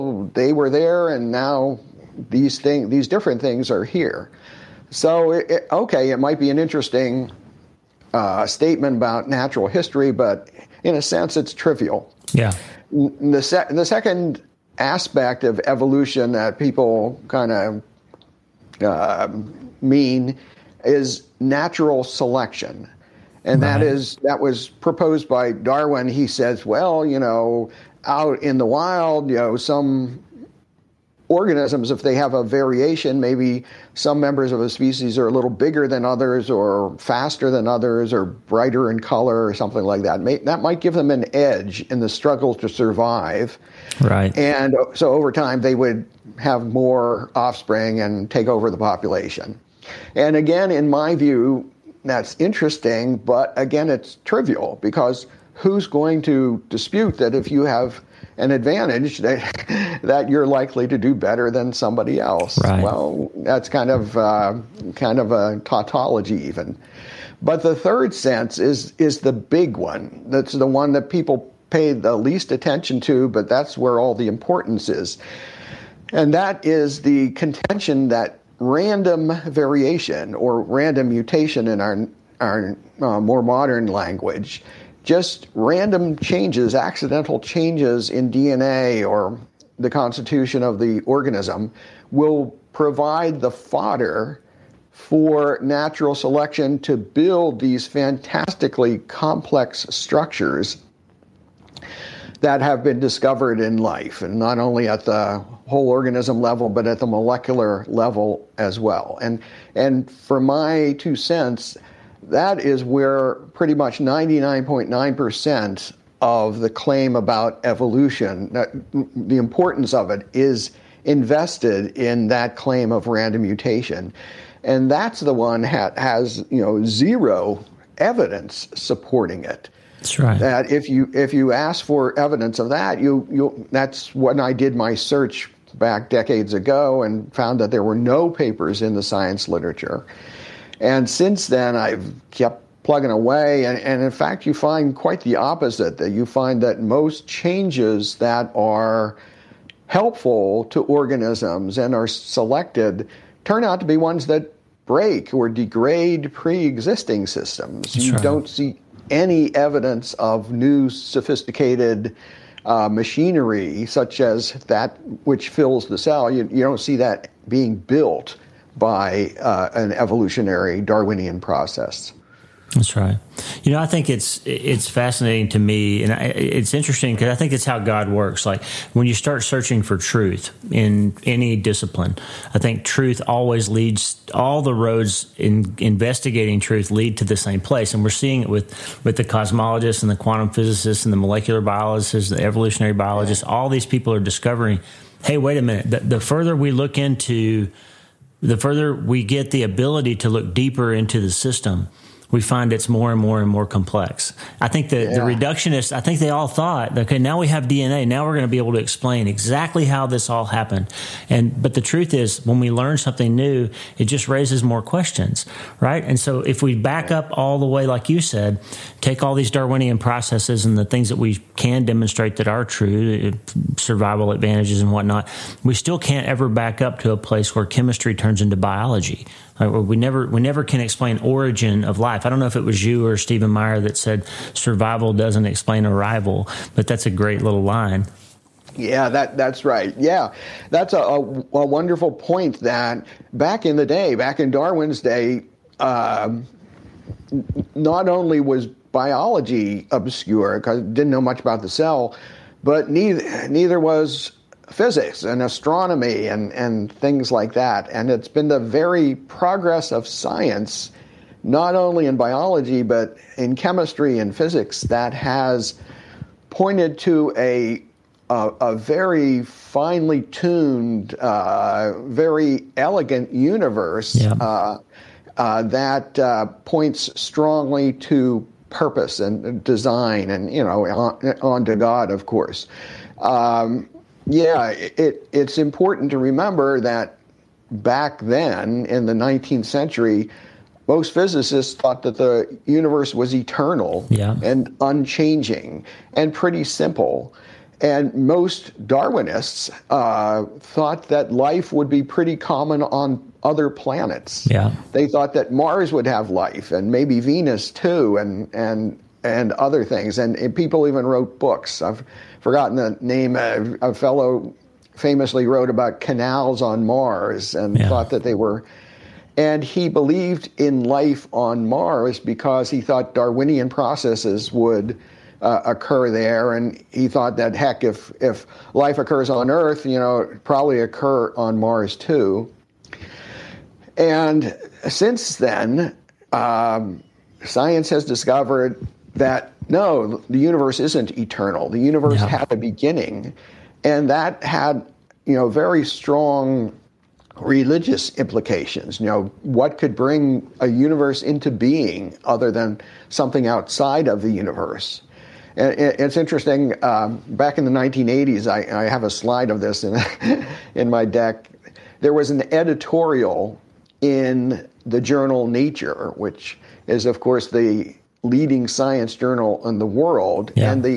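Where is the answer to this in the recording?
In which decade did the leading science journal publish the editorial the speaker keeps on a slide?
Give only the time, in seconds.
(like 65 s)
357 s.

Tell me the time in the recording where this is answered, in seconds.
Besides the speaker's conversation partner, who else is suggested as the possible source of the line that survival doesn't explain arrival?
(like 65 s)
233 s.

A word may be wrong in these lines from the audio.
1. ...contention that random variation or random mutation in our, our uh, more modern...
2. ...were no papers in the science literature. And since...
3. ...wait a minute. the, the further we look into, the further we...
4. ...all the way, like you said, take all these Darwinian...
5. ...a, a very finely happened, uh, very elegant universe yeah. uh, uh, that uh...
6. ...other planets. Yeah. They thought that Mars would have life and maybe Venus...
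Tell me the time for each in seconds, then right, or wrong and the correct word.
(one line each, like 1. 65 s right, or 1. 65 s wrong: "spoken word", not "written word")
1. 77 s right
2. 137 s right
3. 195 s right
4. 217 s right
5. 268 s wrong: "tuned", not "happened"
6. 303 s right.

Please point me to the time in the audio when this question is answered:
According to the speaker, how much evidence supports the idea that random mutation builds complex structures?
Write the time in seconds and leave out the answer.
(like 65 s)
126 s.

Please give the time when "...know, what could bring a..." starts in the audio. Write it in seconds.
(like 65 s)
349 s.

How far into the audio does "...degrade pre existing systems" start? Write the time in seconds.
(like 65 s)
155 s.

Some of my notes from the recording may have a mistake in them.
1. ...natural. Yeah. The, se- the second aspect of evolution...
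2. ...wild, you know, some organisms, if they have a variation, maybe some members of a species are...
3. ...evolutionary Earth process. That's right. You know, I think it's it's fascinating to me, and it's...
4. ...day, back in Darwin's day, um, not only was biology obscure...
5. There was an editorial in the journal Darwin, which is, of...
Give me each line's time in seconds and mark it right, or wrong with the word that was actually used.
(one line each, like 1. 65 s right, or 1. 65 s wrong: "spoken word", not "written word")
1. 11 s wrong: "trivial", not "natural"
2. 28 s right
3. 169 s wrong: "Darwinian", not "Earth"
4. 243 s right
5. 361 s wrong: "Nature", not "Darwin".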